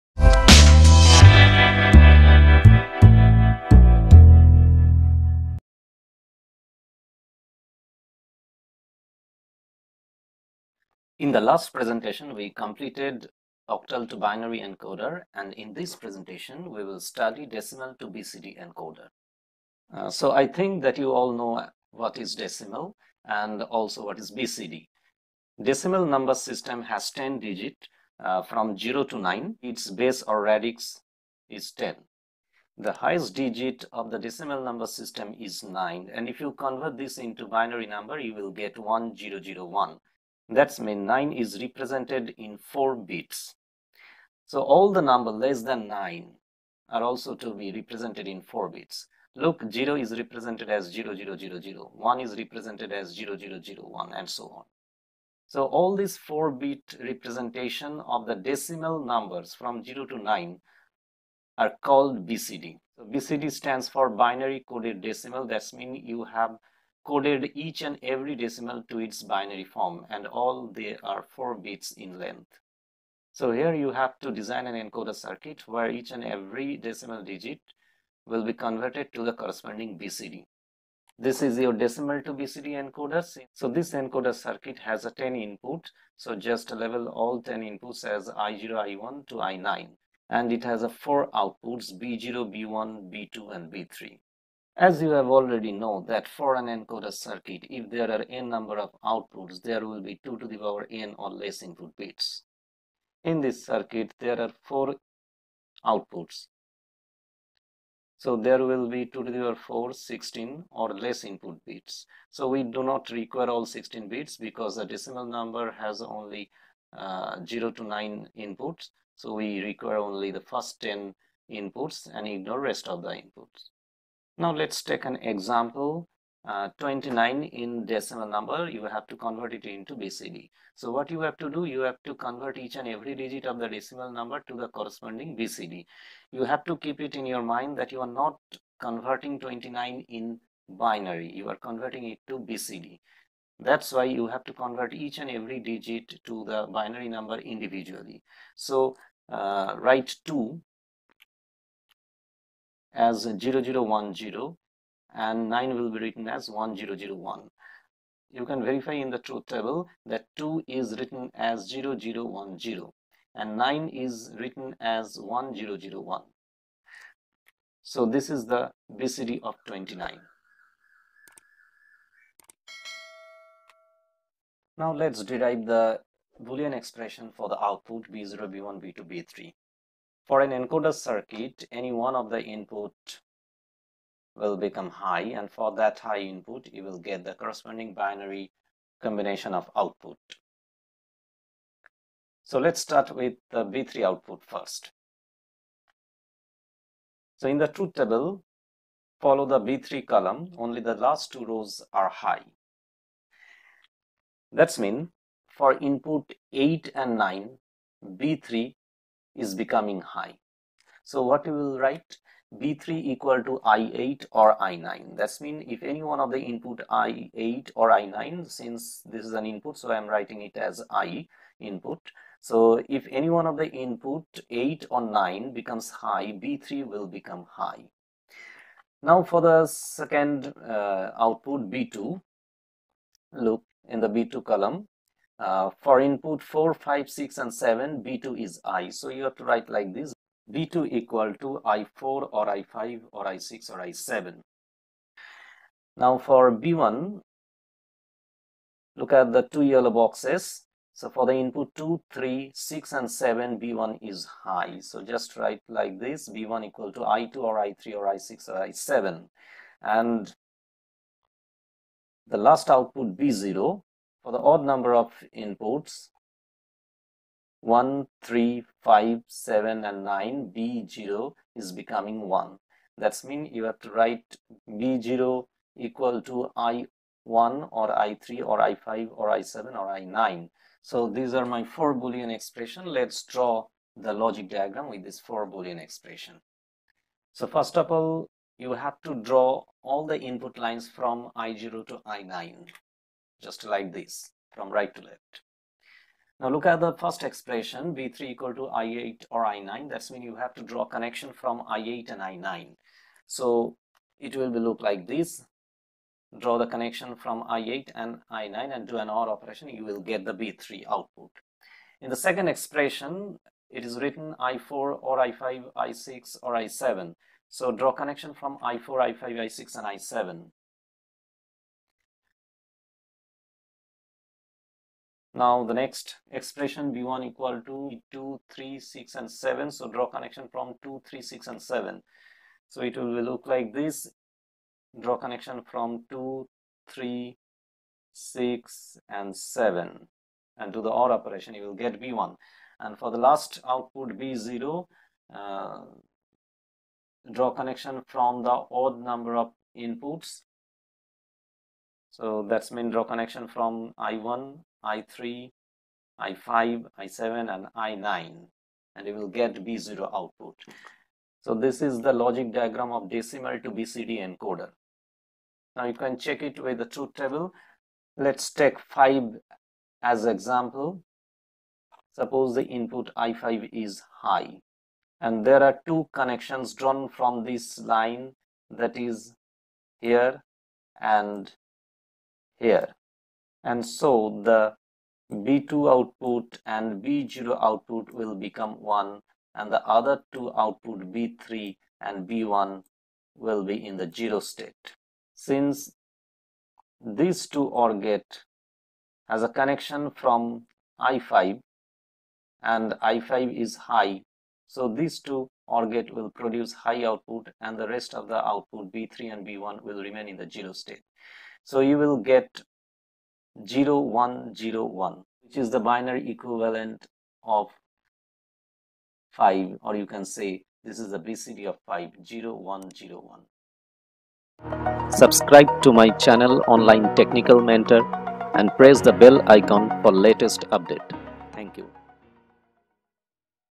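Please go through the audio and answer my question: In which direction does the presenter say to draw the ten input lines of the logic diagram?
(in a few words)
right to left.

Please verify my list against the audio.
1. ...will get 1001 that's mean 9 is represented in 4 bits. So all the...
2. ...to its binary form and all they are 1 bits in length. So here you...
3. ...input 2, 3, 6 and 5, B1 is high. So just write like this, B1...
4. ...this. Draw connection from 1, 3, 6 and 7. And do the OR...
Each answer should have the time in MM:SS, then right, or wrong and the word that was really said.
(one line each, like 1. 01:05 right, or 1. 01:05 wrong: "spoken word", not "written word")
1. 00:38 right
2. 01:08 wrong: "4", not "1"
3. 04:11 wrong: "7", not "5"
4. 05:33 wrong: "2", not "1".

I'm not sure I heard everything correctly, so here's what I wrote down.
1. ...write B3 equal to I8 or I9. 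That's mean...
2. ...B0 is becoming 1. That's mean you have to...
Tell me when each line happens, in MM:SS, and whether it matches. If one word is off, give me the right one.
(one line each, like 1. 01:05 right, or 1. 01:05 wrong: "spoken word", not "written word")
1. 03:31 right
2. 04:30 right.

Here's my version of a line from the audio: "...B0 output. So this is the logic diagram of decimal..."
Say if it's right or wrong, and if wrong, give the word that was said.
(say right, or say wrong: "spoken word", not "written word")
right.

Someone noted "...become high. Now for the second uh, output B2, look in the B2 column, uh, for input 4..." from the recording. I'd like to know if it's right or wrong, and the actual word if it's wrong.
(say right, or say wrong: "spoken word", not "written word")
right.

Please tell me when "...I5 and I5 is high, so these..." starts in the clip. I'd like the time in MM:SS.
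06:40.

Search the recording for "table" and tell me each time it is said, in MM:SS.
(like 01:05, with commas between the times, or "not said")
02:39, 03:17, 06:07.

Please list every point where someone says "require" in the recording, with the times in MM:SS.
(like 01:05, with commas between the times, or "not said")
01:53, 01:59.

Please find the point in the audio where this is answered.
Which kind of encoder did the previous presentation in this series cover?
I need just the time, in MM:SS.
00:13.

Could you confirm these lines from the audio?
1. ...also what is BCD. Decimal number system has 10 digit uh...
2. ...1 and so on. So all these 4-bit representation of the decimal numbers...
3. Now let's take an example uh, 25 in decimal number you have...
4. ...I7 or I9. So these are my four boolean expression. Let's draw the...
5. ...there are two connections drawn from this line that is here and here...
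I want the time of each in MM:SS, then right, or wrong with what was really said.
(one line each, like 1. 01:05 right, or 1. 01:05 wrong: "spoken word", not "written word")
1. 00:23 right
2. 00:53 right
3. 02:04 wrong: "29", not "25"
4. 04:39 right
5. 06:15 right.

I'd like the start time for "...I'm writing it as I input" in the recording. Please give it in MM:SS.
03:39.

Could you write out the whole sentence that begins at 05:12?
In the second expression, it is written I4 or I5, I6 or I7.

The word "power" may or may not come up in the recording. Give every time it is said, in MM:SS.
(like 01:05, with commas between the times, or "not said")
01:40, 01:49.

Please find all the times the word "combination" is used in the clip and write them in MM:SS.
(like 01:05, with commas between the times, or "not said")
03:09.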